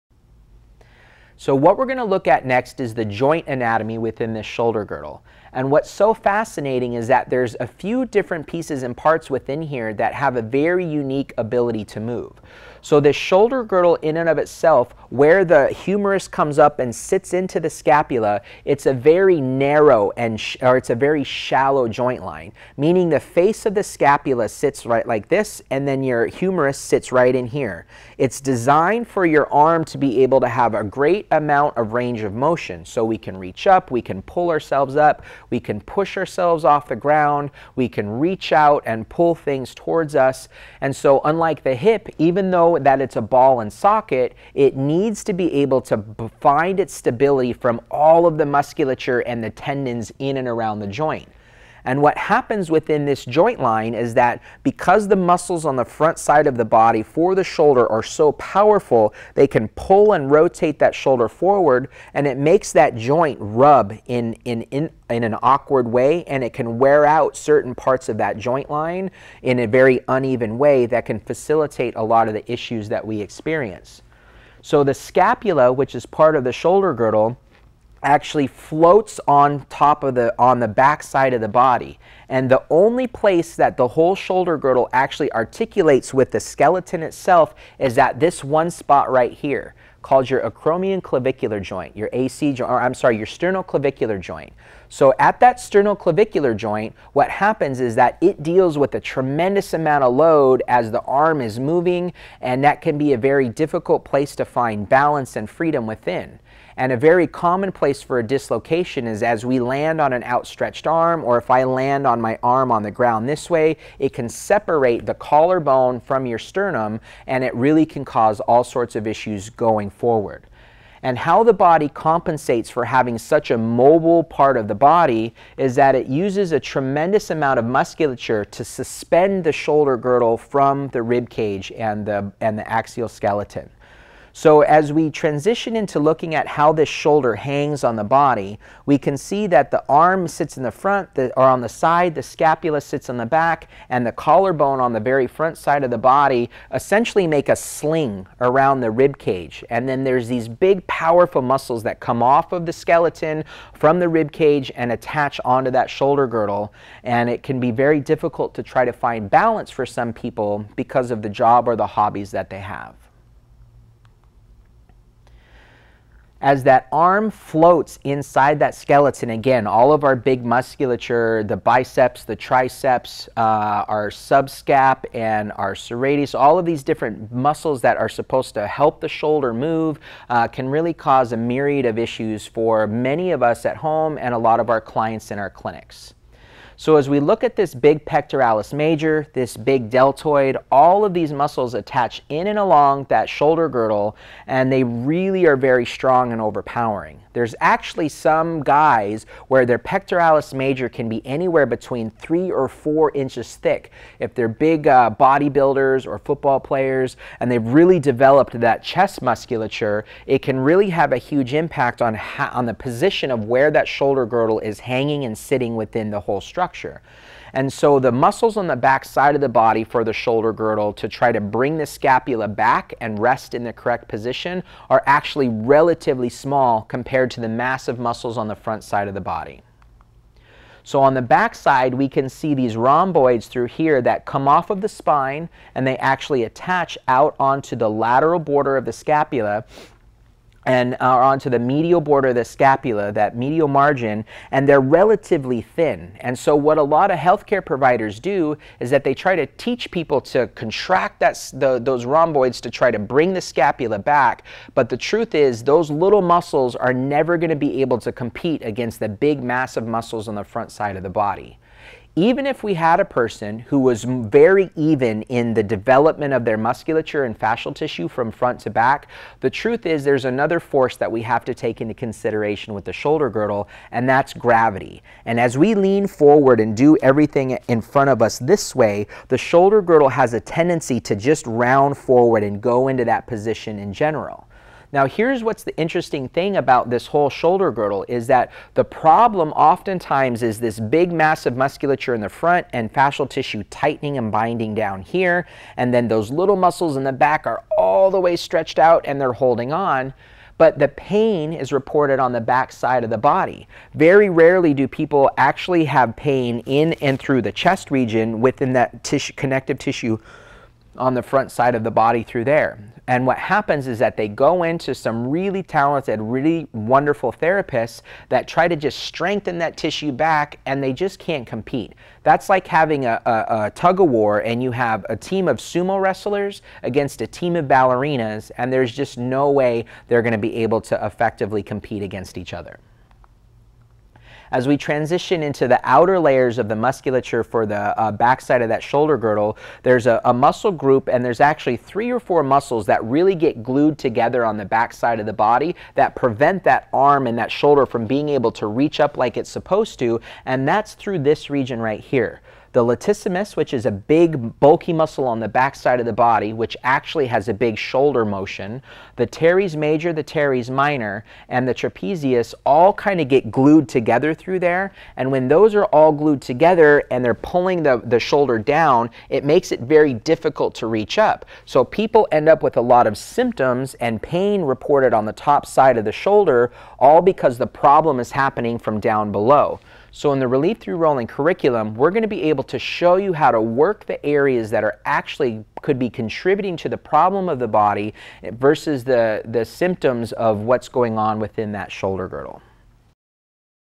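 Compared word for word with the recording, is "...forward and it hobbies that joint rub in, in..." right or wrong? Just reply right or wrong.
wrong.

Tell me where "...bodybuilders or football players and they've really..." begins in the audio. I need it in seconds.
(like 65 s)
205 s.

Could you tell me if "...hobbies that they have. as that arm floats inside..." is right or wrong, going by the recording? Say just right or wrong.
right.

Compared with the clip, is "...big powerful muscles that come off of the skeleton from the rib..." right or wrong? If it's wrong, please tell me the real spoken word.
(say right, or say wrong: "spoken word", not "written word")
right.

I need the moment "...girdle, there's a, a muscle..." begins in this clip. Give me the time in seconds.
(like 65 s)
339 s.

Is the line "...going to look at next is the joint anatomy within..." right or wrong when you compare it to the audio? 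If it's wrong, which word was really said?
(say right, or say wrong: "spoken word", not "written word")
right.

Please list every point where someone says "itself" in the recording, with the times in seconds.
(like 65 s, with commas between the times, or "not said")
14 s, 87 s.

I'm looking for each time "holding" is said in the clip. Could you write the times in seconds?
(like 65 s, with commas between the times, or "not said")
299 s.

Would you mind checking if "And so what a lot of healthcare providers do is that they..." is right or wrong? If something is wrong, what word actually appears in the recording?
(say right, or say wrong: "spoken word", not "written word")
right.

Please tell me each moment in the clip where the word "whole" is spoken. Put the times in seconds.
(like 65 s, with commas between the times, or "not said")
83 s, 216 s, 287 s.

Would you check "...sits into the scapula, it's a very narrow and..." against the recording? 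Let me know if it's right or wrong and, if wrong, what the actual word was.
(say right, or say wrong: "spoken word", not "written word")
right.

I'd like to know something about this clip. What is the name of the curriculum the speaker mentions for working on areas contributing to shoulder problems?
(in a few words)
Relief Through Rolling.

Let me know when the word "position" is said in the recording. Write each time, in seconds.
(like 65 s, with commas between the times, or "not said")
212 s, 224 s, 283 s.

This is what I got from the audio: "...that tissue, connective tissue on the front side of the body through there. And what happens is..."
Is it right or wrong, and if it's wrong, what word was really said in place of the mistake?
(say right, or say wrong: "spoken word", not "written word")
right.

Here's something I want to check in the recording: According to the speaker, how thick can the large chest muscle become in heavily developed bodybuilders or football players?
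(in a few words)
3 or 4 inches.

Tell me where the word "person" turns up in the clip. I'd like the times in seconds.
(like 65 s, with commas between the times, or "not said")
263 s.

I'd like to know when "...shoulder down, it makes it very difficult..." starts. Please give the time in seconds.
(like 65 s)
368 s.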